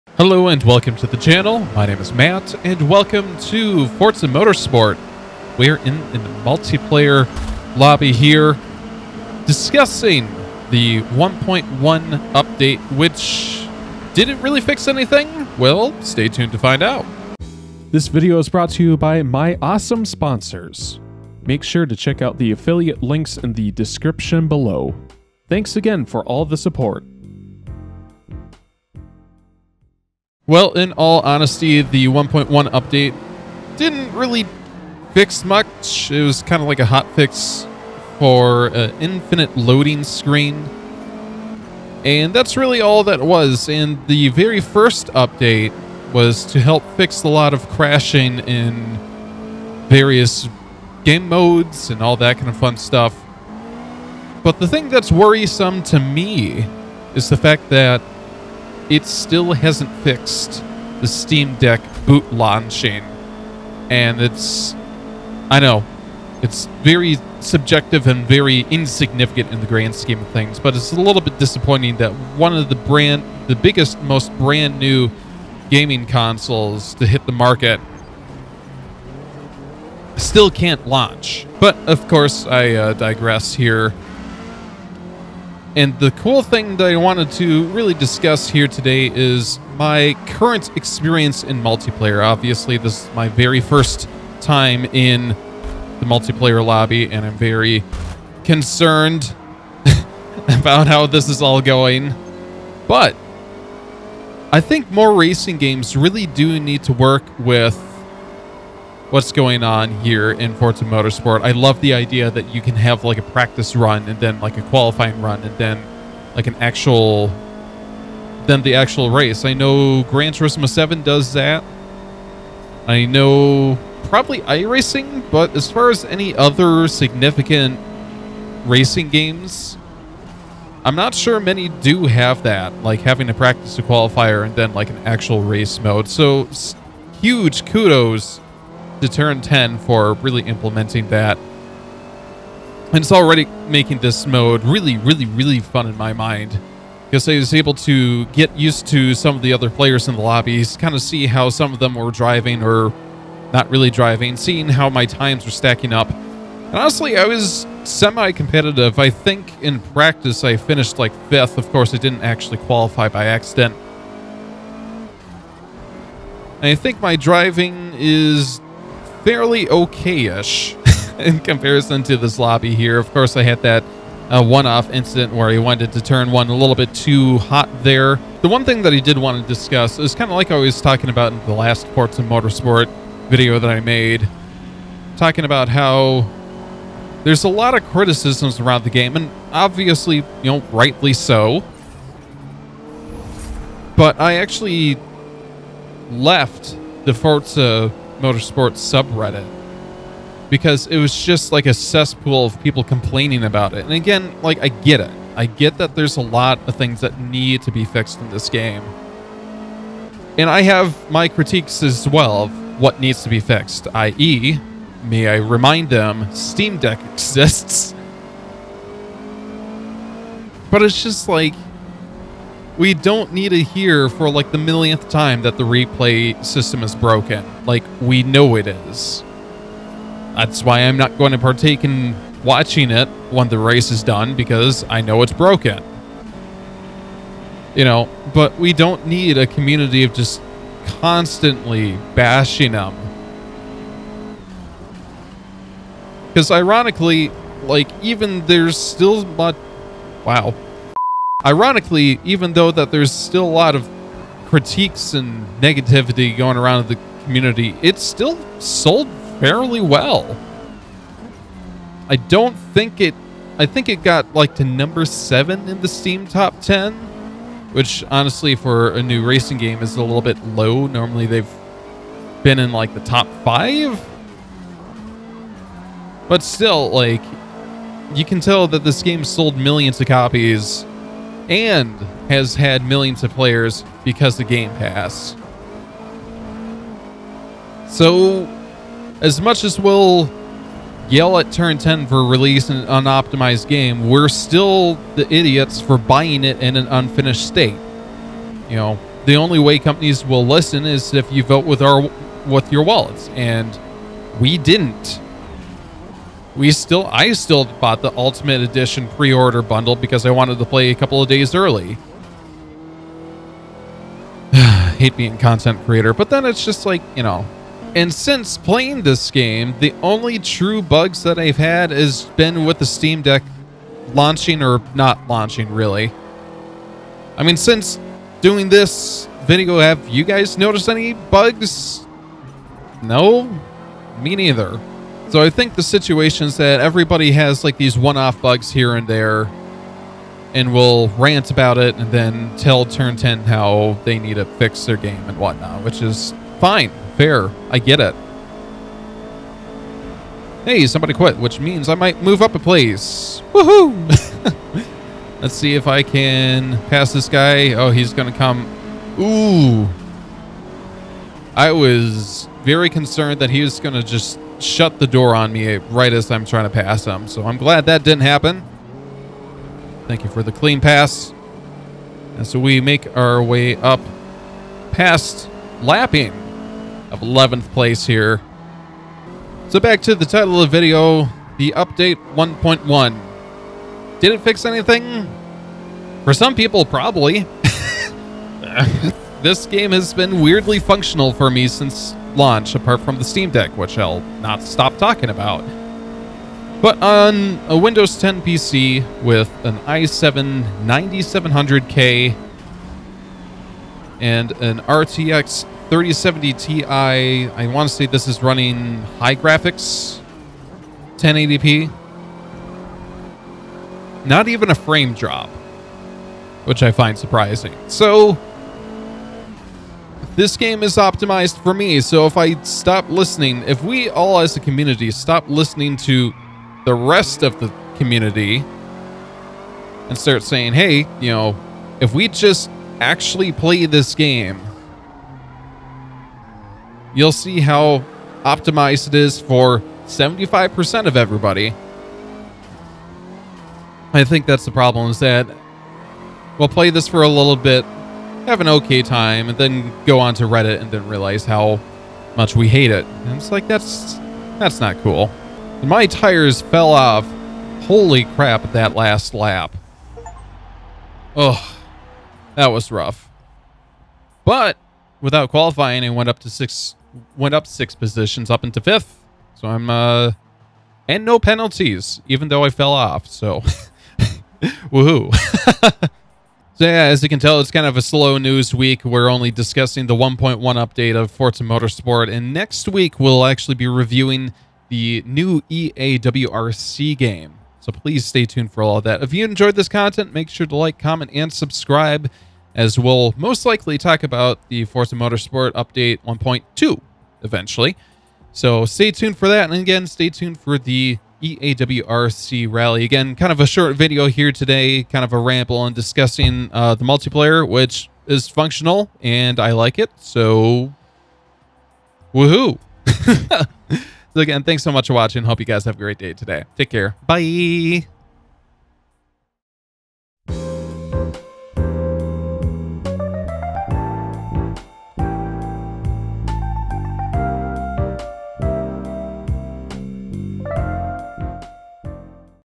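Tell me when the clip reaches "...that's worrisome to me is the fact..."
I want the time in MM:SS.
00:54.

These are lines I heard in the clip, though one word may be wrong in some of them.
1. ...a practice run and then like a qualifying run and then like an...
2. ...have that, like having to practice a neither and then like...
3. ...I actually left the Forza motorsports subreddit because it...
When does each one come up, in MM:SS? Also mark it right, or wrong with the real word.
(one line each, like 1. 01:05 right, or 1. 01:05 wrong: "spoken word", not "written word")
1. 01:53 right
2. 02:12 wrong: "qualifier", not "neither"
3. 03:14 right.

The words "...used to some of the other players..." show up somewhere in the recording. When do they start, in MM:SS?
02:28.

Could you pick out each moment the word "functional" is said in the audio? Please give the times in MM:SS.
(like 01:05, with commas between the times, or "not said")
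06:30, 08:28.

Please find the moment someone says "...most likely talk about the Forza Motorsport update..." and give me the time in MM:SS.
08:13.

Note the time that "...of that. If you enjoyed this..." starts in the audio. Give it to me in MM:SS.
08:08.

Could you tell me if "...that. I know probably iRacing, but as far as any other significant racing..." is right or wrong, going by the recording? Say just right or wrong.
right.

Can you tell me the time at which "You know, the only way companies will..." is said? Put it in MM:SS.
04:58.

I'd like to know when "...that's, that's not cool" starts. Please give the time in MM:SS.
07:33.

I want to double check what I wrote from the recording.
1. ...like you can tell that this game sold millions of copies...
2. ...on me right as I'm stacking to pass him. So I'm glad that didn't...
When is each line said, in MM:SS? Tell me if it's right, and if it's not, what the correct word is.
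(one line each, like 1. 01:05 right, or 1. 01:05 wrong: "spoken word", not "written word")
1. 04:36 right
2. 06:05 wrong: "trying", not "stacking".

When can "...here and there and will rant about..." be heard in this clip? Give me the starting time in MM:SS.
05:38.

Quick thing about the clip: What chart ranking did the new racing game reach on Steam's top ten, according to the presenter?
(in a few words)
7.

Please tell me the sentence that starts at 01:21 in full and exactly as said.
But of course, I uh, digress here.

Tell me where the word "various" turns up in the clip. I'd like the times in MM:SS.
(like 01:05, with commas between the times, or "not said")
00:49.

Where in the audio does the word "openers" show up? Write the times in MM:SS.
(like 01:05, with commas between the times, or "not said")
not said.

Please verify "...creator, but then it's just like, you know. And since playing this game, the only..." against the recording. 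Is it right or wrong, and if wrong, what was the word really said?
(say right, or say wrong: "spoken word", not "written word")
right.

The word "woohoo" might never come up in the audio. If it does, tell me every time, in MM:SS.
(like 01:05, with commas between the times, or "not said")
05:53, 07:54, 08:32.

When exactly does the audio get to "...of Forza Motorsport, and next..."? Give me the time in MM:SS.
08:01.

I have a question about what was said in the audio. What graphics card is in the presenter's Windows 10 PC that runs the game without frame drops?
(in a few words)
RTX 3070 Ti.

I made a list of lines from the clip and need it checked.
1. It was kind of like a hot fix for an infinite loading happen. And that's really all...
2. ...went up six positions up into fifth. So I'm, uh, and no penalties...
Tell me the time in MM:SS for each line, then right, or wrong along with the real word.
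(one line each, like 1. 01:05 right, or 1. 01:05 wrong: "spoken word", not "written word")
1. 00:36 wrong: "screen", not "happen"
2. 07:47 right.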